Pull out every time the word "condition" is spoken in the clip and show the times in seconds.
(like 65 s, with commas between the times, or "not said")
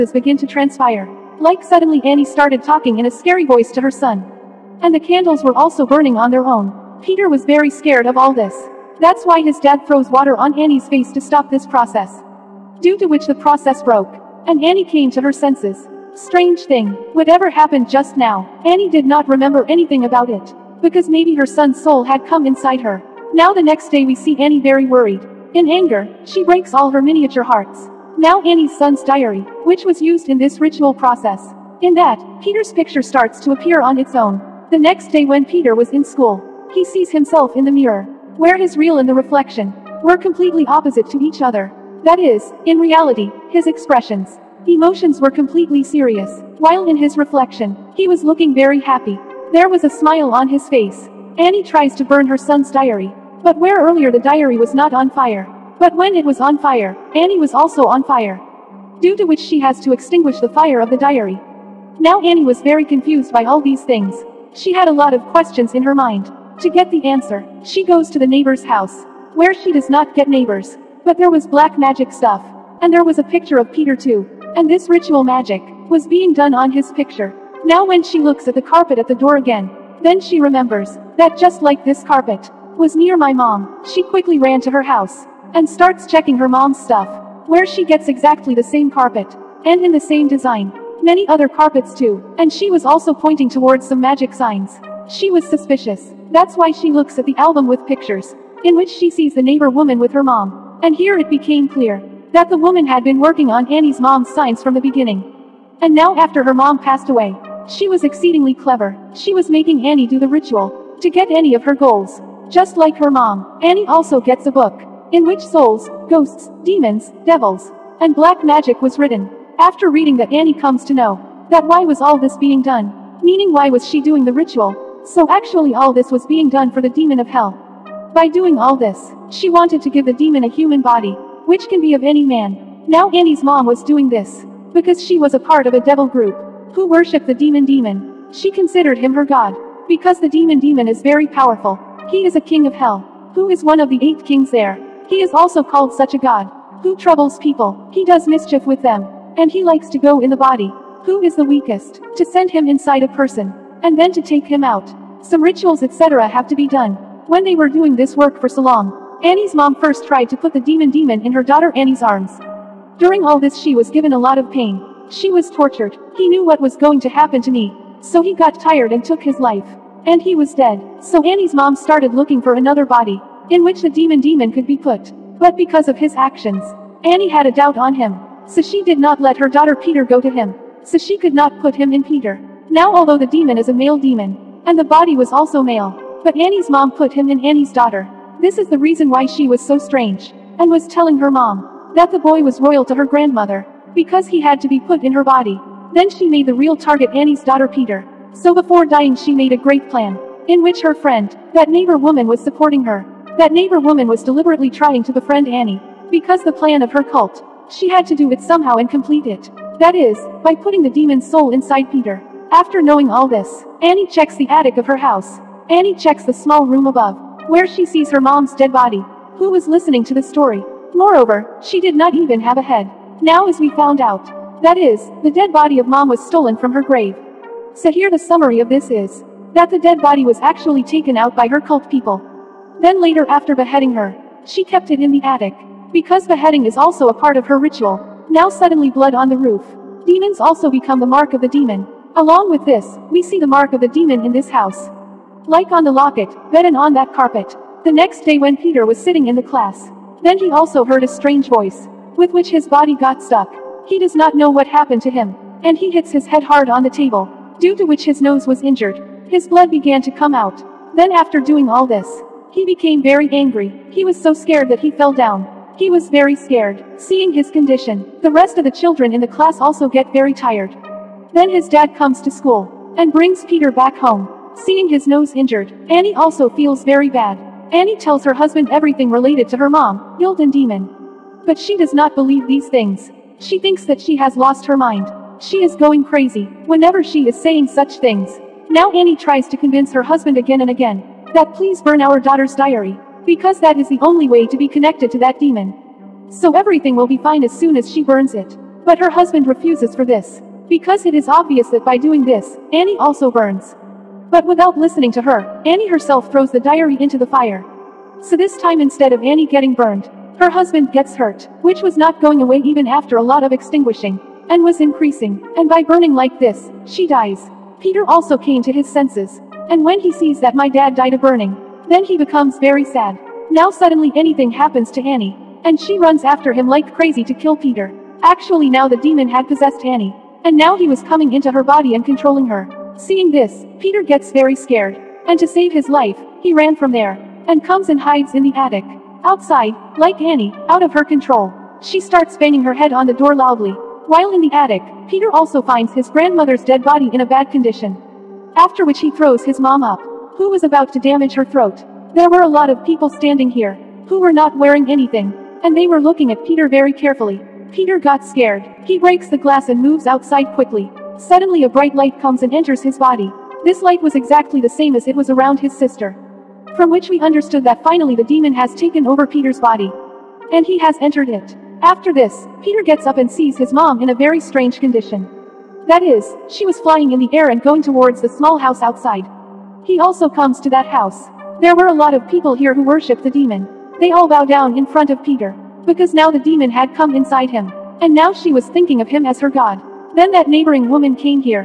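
267 s, 347 s, 374 s.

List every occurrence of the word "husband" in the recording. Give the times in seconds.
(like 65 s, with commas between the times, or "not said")
278 s, 290 s, 299 s, 310 s.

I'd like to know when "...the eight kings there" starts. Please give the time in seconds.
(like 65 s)
143 s.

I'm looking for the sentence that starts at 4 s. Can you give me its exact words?
And the candles were also burning on their own.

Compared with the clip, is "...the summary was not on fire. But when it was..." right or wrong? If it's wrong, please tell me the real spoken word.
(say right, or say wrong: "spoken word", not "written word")
wrong: "diary", not "summary".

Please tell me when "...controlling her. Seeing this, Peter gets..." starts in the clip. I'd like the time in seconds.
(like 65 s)
332 s.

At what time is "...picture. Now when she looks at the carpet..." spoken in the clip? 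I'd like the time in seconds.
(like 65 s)
76 s.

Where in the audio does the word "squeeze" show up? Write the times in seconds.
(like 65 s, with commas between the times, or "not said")
not said.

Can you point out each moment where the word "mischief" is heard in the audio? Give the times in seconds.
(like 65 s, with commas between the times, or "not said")
148 s.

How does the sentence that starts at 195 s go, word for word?
Then she made the real target Annie's daughter Peter.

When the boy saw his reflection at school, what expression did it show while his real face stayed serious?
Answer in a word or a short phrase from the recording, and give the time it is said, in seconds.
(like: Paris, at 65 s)
A smile, at 49 s.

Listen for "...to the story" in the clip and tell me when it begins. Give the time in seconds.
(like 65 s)
220 s.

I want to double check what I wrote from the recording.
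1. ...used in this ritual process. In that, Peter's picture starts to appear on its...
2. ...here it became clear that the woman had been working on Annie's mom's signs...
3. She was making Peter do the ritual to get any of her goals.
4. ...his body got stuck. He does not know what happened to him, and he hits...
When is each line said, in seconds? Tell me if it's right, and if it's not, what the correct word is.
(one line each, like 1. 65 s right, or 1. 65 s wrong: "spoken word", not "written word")
1. 30 s right
2. 100 s right
3. 109 s wrong: "Annie", not "Peter"
4. 252 s right.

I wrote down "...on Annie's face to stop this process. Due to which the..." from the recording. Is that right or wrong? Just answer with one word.
right.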